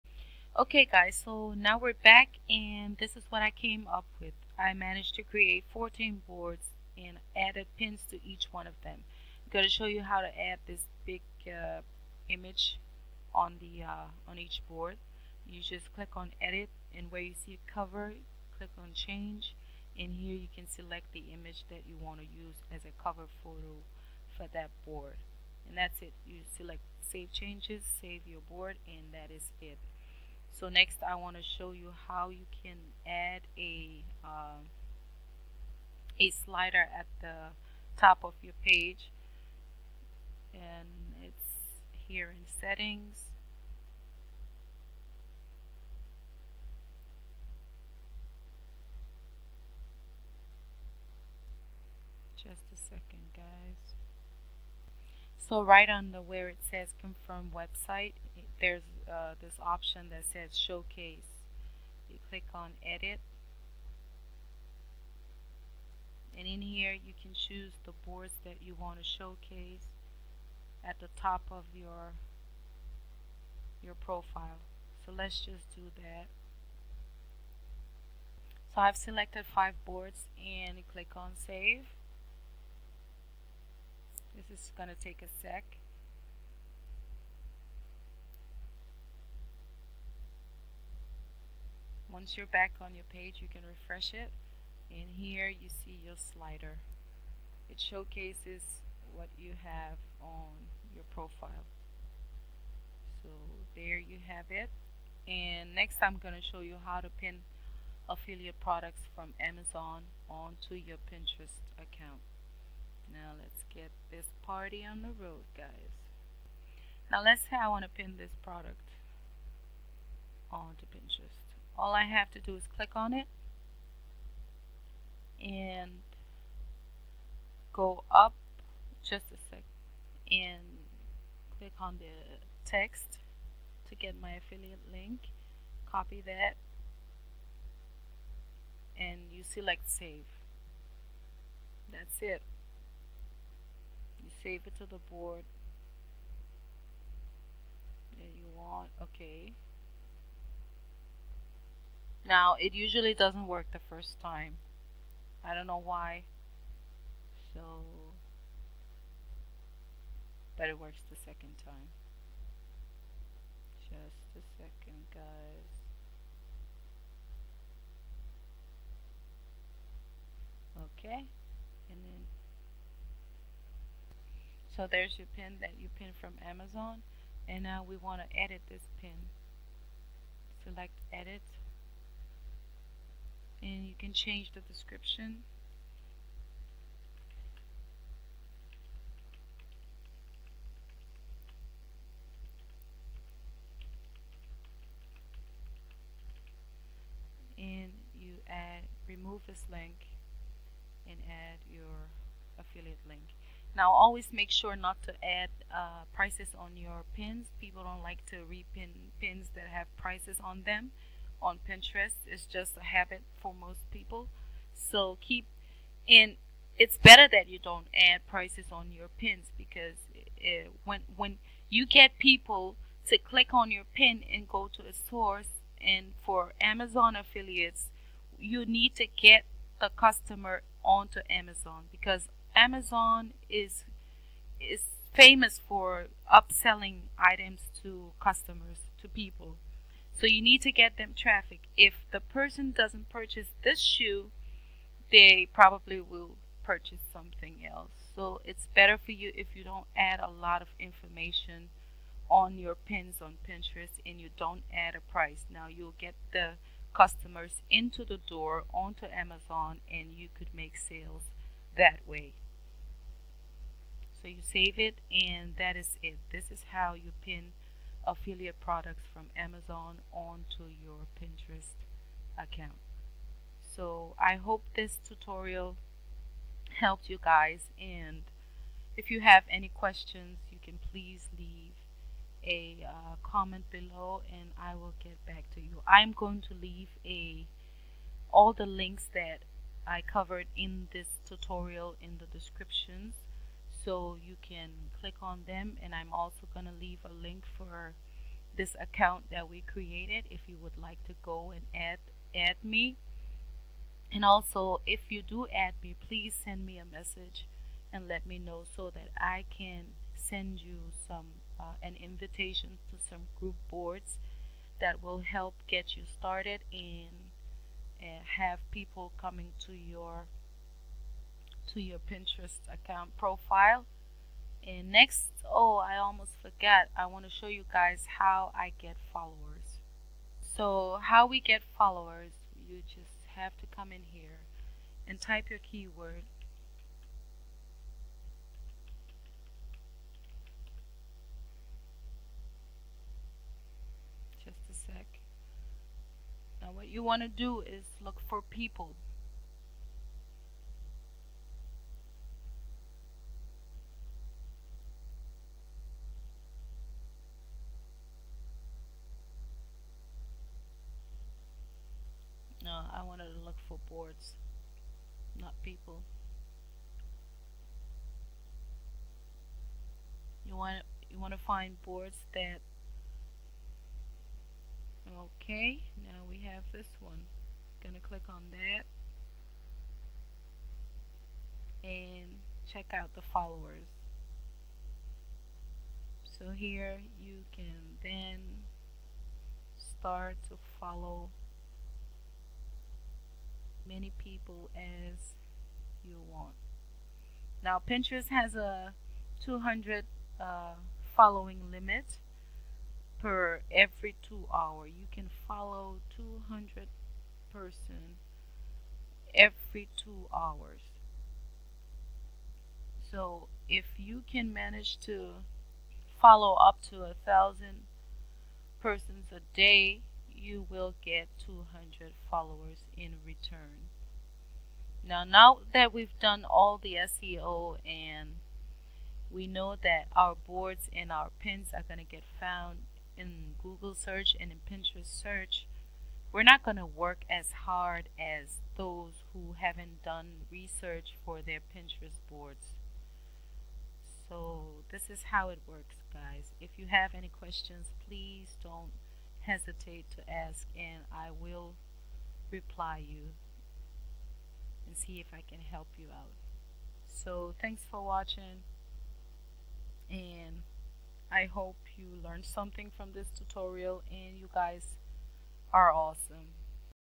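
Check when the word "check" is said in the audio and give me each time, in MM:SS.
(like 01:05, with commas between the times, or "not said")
06:22.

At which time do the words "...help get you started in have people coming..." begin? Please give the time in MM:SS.
05:15.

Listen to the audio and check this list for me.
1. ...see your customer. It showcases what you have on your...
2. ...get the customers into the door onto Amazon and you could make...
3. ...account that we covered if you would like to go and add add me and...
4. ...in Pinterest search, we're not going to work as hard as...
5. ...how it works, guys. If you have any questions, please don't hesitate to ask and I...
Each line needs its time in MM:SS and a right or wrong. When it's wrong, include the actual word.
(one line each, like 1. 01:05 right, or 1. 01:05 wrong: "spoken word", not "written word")
1. 01:35 wrong: "slider", not "customer"
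2. 04:15 right
3. 04:58 wrong: "created", not "covered"
4. 07:14 right
5. 07:25 right.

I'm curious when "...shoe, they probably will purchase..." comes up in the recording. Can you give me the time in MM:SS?
04:03.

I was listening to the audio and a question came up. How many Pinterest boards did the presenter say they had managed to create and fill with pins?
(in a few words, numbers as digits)
14.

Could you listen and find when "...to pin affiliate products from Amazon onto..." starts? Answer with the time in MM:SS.
01:46.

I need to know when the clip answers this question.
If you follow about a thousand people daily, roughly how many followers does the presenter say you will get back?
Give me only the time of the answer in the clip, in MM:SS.
07:01.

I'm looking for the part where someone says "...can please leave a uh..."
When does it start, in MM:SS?
04:40.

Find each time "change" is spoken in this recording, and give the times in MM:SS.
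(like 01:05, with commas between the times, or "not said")
00:18, 00:27, 03:04.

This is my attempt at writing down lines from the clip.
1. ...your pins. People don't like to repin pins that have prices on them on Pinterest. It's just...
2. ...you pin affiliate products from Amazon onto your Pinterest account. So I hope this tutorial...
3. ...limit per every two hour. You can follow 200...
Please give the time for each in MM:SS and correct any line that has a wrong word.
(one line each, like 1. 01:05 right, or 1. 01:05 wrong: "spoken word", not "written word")
1. 03:26 right
2. 04:26 right
3. 06:41 right.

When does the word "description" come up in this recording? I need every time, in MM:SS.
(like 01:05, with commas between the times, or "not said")
03:04, 04:52.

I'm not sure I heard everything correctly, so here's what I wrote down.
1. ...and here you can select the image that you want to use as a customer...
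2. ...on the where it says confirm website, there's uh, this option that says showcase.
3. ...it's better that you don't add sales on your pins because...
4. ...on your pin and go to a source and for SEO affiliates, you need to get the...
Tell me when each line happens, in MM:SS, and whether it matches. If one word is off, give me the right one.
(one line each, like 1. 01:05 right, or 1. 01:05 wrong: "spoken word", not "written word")
1. 00:19 wrong: "cover", not "customer"
2. 00:55 right
3. 03:36 wrong: "prices", not "sales"
4. 03:43 wrong: "Amazon", not "SEO".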